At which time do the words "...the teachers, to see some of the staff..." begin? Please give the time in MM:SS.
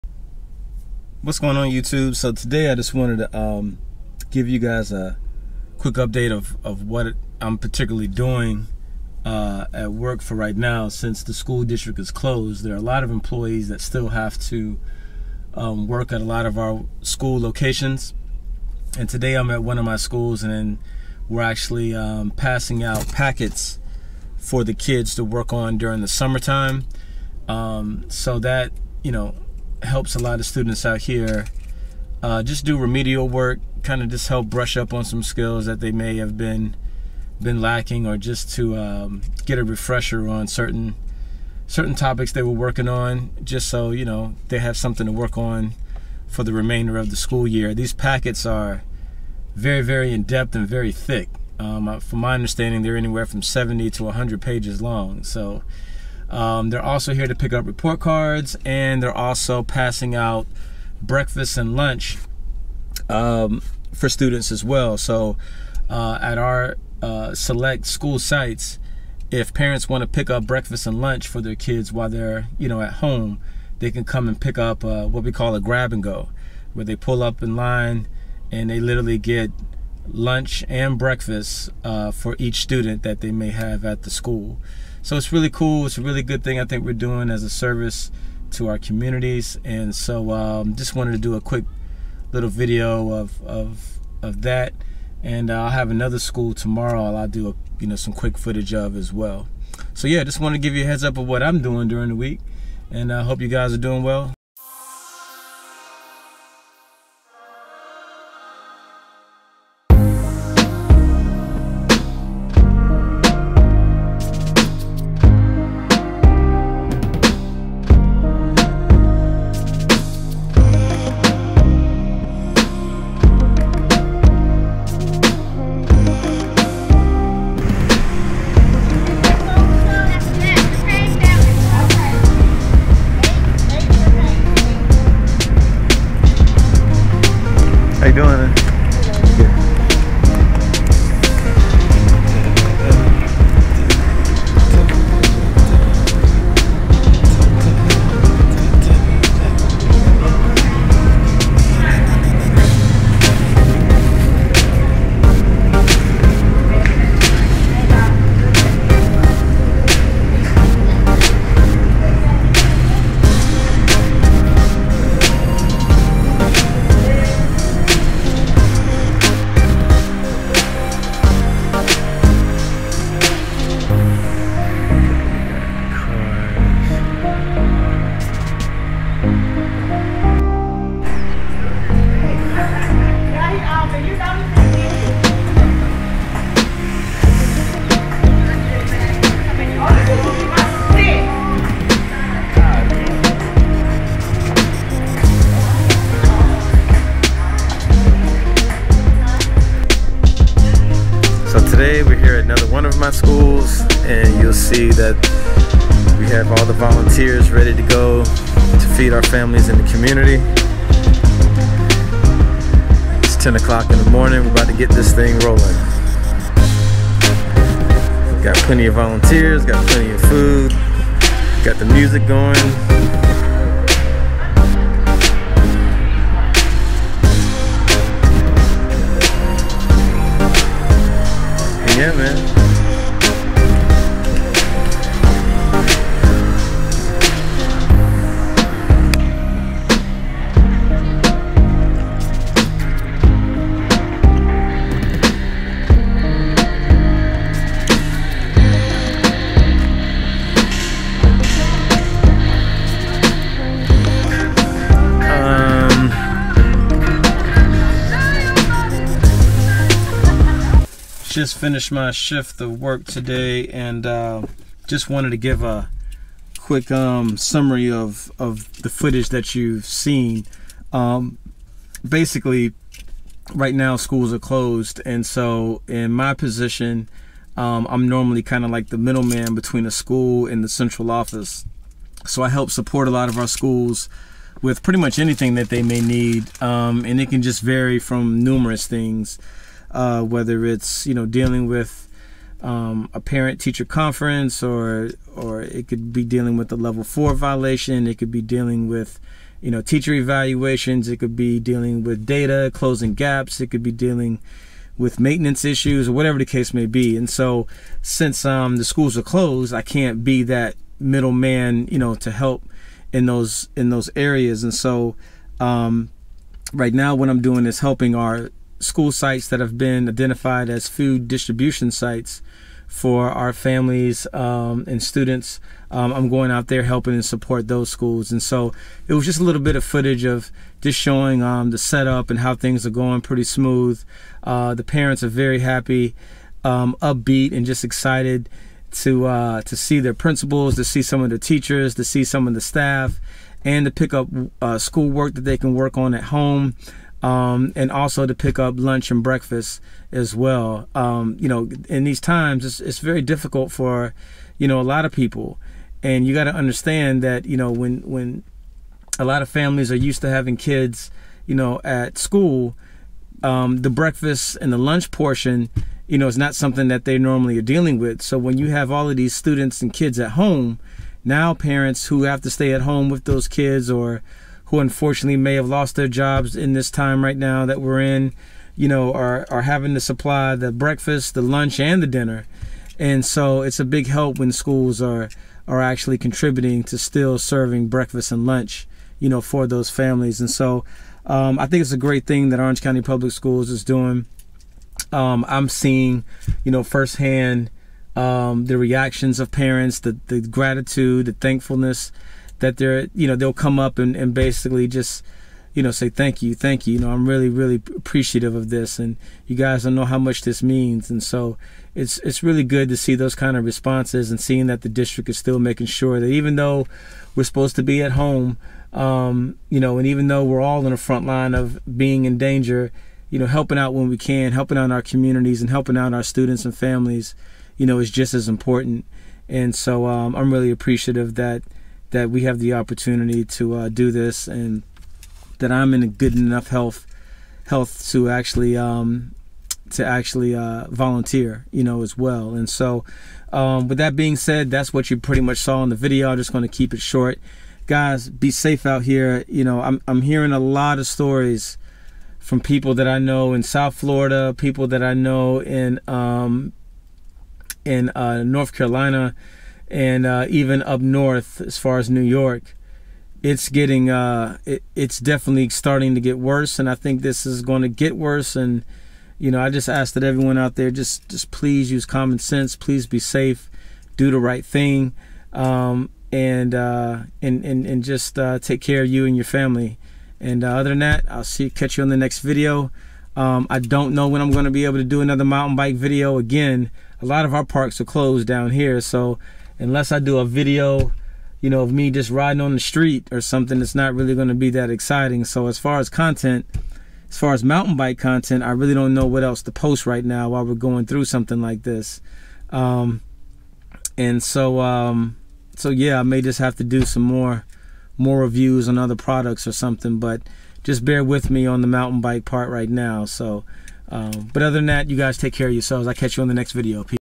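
05:41.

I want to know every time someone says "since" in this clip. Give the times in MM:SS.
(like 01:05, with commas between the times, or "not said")
00:10, 05:08.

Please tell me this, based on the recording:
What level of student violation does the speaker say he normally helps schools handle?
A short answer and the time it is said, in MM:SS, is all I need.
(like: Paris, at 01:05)
level four, at 04:56.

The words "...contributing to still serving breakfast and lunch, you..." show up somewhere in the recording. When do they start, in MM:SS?
06:26.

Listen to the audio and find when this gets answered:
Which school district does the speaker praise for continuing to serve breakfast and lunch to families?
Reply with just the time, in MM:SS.
06:32.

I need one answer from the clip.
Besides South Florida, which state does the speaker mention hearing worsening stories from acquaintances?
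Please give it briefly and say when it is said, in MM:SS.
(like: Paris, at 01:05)
North Carolina, at 07:38.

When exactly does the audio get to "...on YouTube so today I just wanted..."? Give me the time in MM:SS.
00:01.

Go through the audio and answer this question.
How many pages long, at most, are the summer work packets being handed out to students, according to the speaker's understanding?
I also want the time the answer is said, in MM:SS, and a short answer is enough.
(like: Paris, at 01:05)
100, at 00:54.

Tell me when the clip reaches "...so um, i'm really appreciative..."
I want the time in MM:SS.
07:09.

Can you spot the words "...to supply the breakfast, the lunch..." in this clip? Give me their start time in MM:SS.
06:19.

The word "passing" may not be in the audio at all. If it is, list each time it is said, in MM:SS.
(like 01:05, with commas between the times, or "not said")
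00:22, 00:59.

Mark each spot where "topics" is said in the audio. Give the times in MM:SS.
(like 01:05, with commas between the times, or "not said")
00:41.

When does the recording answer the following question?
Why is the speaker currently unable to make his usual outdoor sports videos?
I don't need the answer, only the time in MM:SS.
08:07.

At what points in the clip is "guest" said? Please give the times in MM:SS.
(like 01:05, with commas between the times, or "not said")
not said.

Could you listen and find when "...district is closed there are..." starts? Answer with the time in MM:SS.
00:11.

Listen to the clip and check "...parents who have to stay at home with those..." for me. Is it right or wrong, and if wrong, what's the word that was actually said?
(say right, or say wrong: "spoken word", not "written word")
right.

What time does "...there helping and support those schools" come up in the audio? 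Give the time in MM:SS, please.
05:26.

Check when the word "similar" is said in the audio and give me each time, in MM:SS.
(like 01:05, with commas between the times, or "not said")
not said.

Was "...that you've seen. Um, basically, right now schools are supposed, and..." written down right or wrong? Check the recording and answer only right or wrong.
wrong.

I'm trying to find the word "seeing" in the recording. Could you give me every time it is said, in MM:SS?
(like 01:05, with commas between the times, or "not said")
06:35, 06:54.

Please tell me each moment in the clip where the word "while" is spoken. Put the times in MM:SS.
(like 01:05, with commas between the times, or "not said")
01:11, 08:20.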